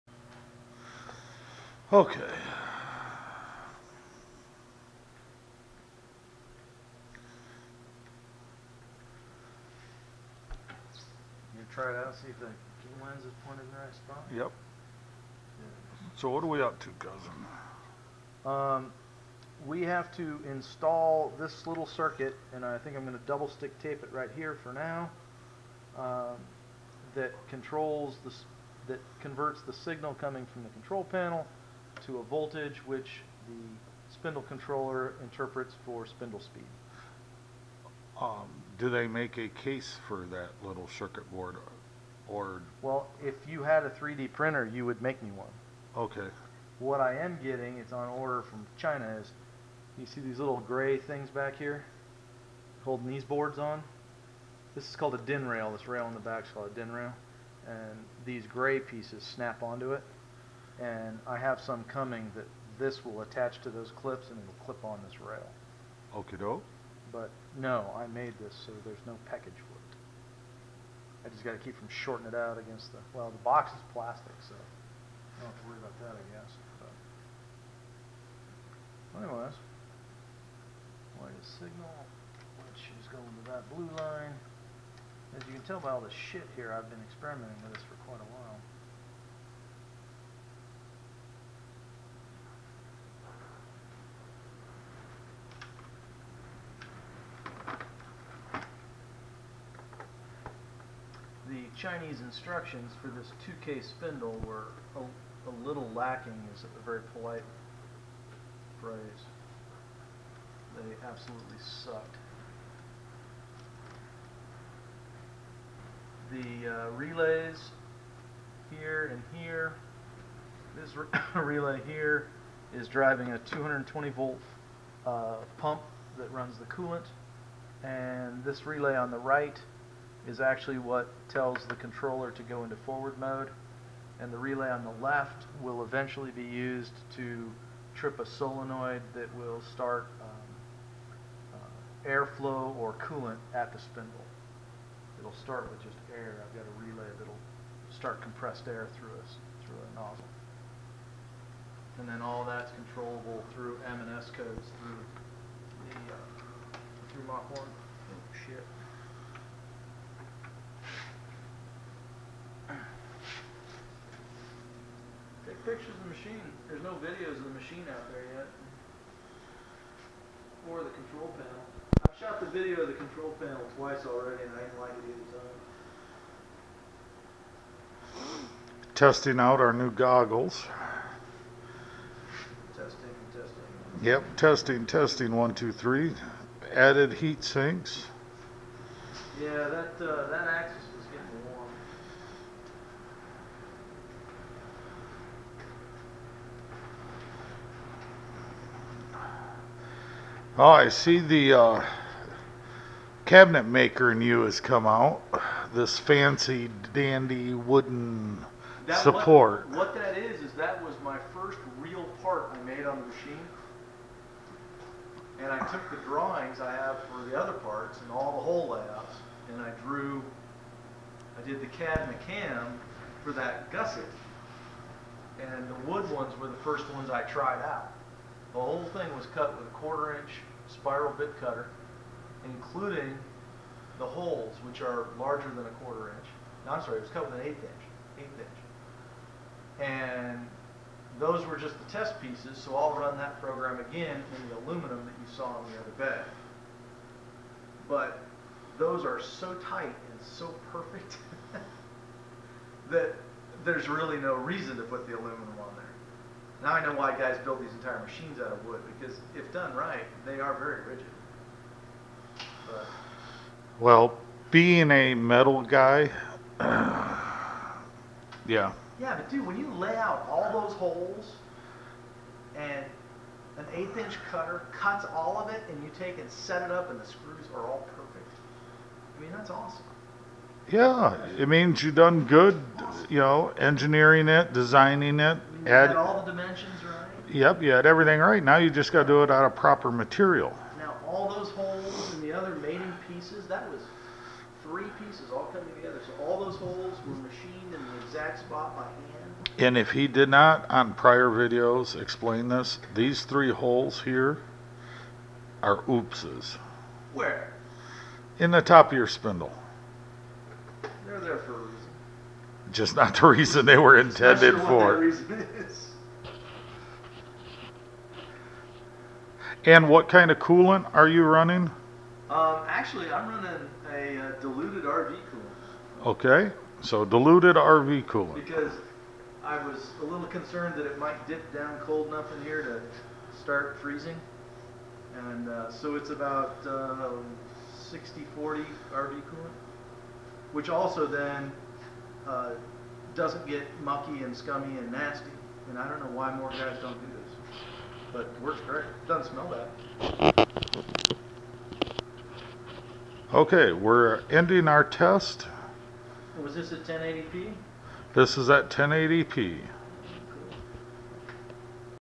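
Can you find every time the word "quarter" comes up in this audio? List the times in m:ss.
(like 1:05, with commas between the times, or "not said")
3:49, 3:55.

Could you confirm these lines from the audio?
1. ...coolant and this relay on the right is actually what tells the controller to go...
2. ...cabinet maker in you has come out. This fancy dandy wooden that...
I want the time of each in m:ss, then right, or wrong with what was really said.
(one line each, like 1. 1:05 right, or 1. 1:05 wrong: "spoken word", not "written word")
1. 2:06 right
2. 3:23 right.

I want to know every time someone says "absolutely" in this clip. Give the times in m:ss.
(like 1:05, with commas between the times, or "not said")
1:51.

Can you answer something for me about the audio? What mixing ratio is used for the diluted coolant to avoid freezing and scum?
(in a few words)
60 40.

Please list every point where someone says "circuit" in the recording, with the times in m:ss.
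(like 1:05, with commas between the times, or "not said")
0:21, 0:40.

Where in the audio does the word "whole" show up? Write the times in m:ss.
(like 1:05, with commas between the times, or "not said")
3:38, 3:48.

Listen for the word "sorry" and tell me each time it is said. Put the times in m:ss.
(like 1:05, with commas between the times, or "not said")
3:56.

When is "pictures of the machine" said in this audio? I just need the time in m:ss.
2:45.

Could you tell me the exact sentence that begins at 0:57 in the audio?
And these gray pieces snap onto it.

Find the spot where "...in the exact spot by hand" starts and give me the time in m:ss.
4:57.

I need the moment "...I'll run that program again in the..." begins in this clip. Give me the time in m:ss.
4:02.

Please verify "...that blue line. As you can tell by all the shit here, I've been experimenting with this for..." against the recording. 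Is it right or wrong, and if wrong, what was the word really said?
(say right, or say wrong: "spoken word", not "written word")
right.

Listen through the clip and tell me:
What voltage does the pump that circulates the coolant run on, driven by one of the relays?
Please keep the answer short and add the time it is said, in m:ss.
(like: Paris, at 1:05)
220 volt, at 2:03.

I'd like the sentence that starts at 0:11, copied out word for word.
You try it out, see if the lens is pointed in the right spot?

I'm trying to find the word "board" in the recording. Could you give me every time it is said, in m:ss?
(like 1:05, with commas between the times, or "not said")
0:41, 0:53.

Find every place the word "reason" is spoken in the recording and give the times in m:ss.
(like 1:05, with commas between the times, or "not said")
4:14, 5:13.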